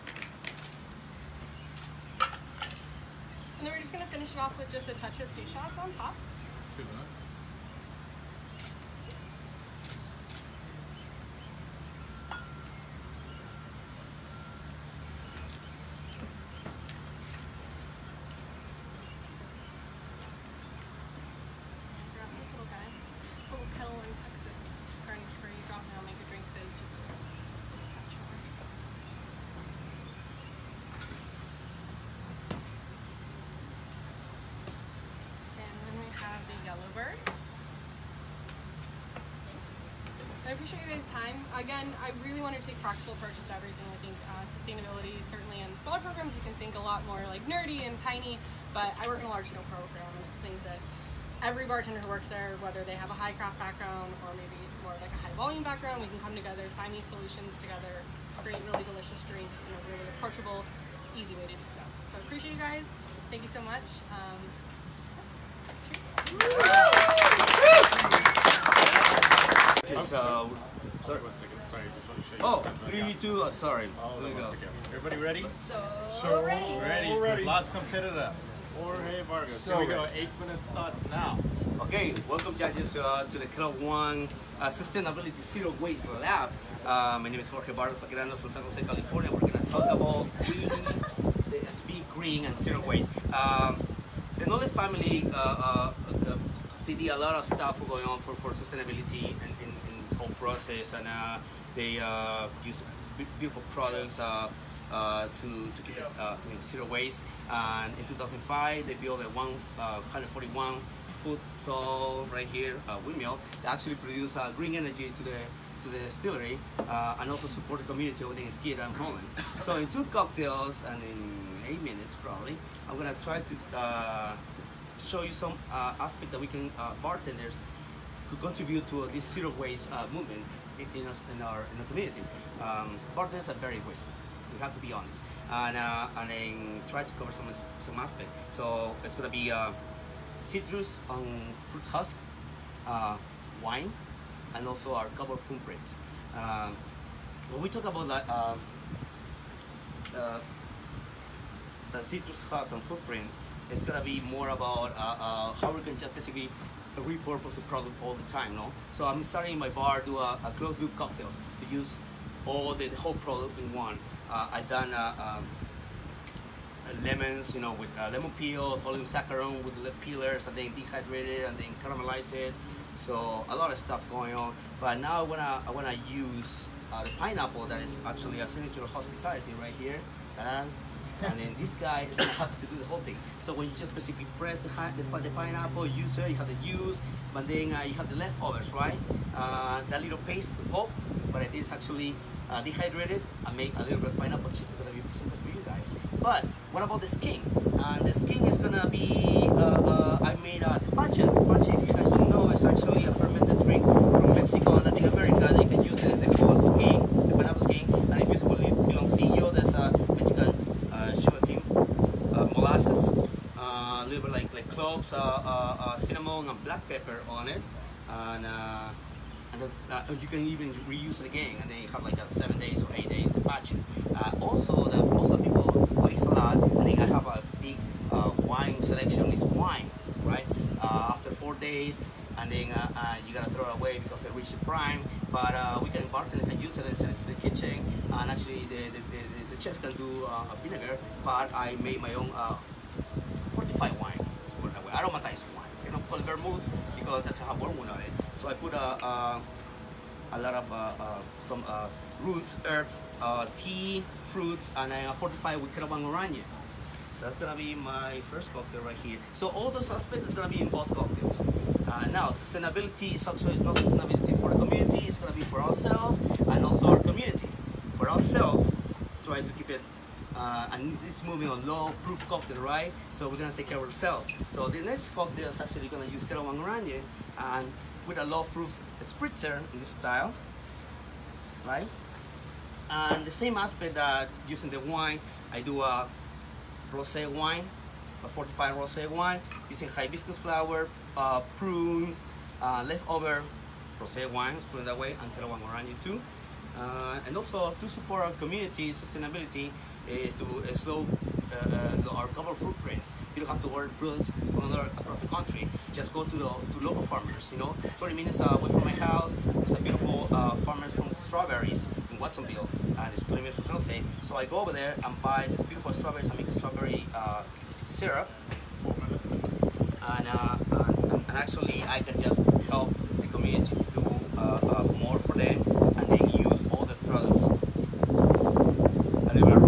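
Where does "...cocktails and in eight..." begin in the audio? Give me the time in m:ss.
2:00.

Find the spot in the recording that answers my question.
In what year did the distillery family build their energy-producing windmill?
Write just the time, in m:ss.
1:48.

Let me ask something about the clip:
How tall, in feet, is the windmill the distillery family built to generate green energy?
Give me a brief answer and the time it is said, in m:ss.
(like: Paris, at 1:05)
141 feet, at 1:49.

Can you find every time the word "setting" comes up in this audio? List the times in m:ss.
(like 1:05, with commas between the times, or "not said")
not said.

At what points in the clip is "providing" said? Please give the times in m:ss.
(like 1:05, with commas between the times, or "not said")
not said.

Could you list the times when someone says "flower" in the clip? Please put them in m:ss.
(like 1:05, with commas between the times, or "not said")
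4:50.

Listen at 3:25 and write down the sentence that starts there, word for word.
They can use the, the whole skin, the pineapple skin, and if you like cloves, cinnamon, and black pepper on it.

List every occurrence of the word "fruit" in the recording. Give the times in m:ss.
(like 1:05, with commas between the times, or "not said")
2:21, 4:14.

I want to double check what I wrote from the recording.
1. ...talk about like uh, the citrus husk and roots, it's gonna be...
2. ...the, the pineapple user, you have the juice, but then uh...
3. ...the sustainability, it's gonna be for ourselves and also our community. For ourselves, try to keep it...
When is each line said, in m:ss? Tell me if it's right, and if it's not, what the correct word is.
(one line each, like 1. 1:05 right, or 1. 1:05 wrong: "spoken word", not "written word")
1. 2:27 wrong: "footprints", not "roots"
2. 3:04 right
3. 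4:24 wrong: "community", not "sustainability".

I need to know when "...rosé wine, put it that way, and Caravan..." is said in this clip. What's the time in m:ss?
4:53.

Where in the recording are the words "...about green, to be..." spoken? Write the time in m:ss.
1:29.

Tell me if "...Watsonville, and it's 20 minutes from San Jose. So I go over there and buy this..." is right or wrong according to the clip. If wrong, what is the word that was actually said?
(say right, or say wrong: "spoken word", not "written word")
right.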